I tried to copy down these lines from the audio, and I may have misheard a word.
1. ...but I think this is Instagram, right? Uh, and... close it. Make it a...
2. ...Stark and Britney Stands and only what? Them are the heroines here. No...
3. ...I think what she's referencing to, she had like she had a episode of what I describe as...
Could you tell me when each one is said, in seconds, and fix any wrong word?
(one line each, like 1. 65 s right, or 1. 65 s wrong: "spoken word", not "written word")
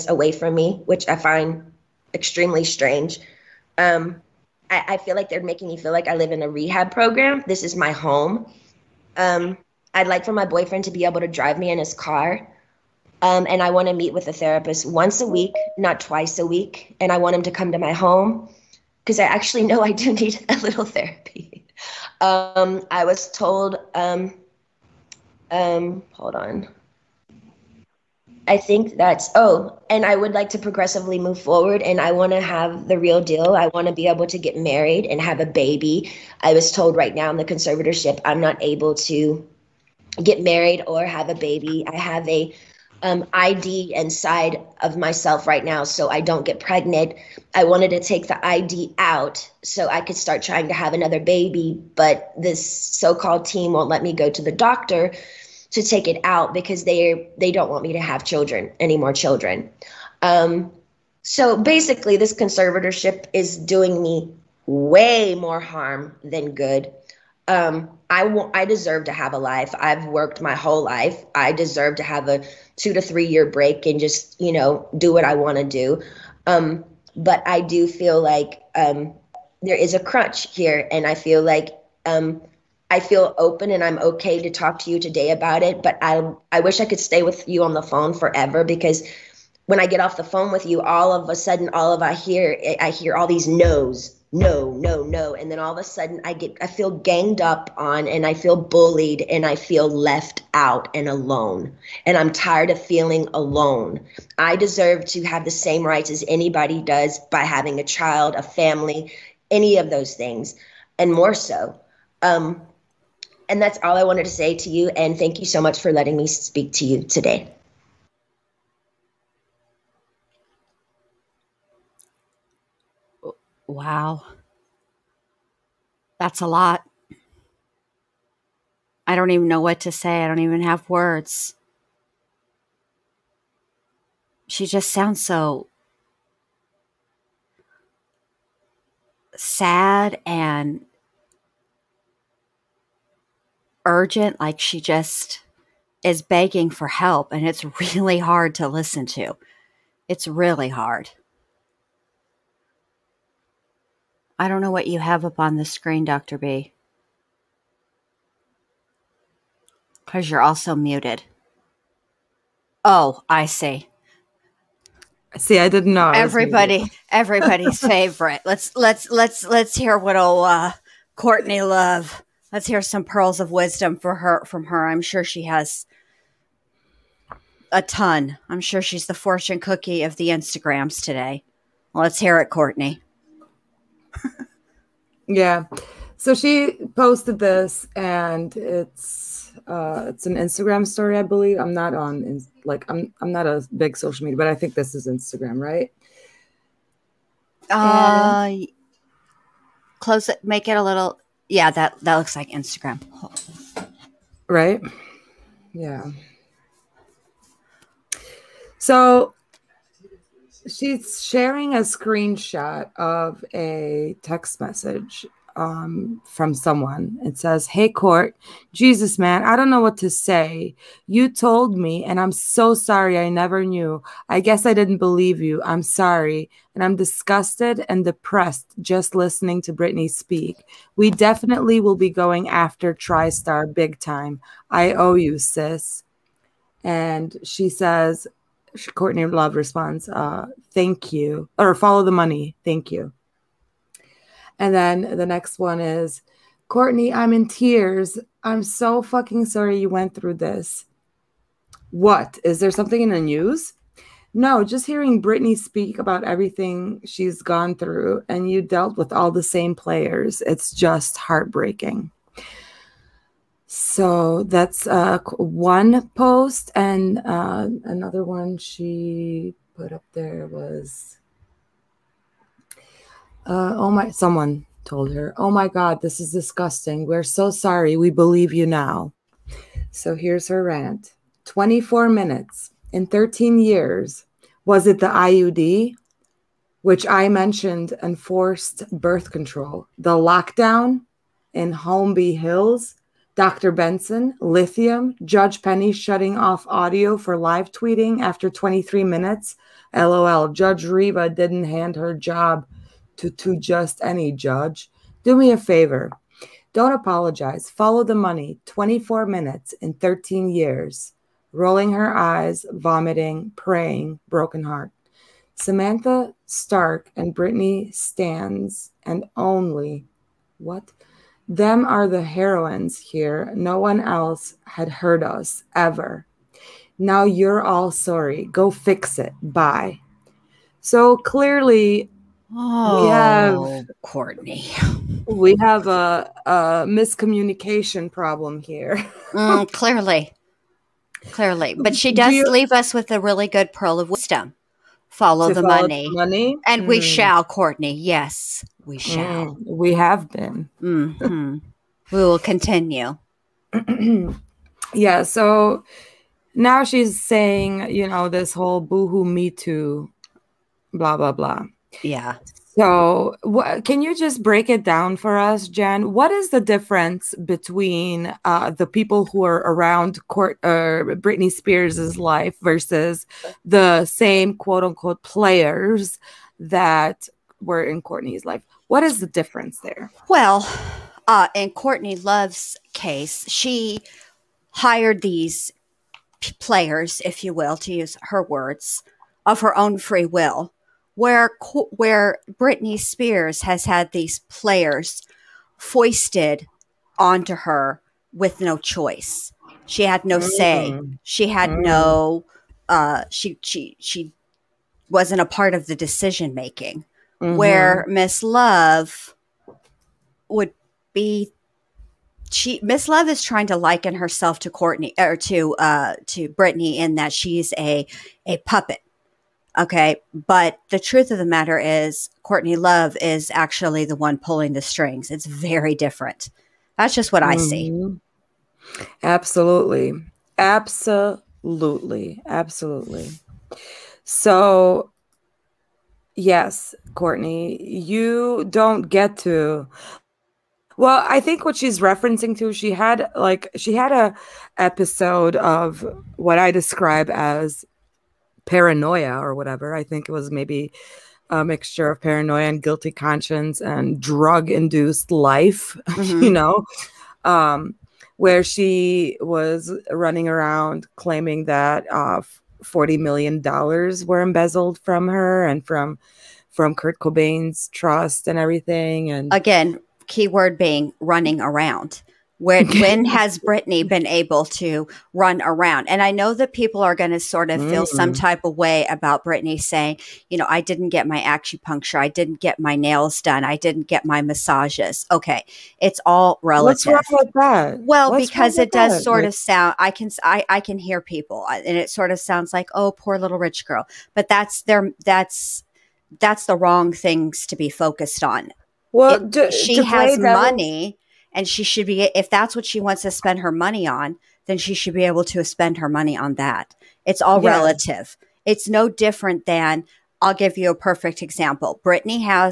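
1. 194 s right
2. 316 s right
3. 441 s right.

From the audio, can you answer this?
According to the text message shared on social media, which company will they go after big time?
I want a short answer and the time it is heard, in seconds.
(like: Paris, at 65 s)
TriStar, at 232 s.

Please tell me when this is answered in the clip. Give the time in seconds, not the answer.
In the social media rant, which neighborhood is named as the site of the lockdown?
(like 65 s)
291 s.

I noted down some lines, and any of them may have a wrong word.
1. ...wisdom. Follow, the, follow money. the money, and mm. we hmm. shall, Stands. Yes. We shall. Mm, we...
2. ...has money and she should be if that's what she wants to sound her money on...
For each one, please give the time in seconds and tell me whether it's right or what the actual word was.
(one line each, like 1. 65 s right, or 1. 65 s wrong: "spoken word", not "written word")
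1. 344 s wrong: "Courtney", not "Stands"
2. 500 s wrong: "spend", not "sound".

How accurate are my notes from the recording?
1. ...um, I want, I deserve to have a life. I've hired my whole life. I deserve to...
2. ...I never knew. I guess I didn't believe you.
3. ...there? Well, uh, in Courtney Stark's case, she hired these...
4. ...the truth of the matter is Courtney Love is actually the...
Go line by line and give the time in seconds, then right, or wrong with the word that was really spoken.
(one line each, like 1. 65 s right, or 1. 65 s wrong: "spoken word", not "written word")
1. 67 s wrong: "worked", not "hired"
2. 223 s right
3. 379 s wrong: "Love", not "Stark"
4. 420 s right.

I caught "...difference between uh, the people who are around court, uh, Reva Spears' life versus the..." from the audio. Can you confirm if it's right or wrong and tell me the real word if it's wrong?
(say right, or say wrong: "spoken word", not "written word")
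wrong: "Britney", not "Reva".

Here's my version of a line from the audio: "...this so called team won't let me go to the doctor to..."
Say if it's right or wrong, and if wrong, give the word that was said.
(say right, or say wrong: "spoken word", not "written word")
right.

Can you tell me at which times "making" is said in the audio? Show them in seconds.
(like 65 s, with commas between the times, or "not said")
5 s, 406 s.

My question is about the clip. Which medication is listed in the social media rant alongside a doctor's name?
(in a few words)
Lithium.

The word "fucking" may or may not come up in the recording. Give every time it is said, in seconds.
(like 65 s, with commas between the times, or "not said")
249 s.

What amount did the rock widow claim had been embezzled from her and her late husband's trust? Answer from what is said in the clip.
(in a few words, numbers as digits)
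40 million dollars.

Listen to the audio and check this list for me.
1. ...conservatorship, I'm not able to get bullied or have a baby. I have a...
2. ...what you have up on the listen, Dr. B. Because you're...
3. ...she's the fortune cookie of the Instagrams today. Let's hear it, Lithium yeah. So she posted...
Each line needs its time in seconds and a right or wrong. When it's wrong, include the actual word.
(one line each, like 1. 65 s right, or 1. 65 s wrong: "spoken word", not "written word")
1. 37 s wrong: "married", not "bullied"
2. 154 s wrong: "screen", not "listen"
3. 178 s wrong: "Courtney", not "Lithium".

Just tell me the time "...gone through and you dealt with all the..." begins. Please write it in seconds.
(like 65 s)
257 s.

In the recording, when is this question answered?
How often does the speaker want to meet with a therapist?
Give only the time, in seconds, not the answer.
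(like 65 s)
14 s.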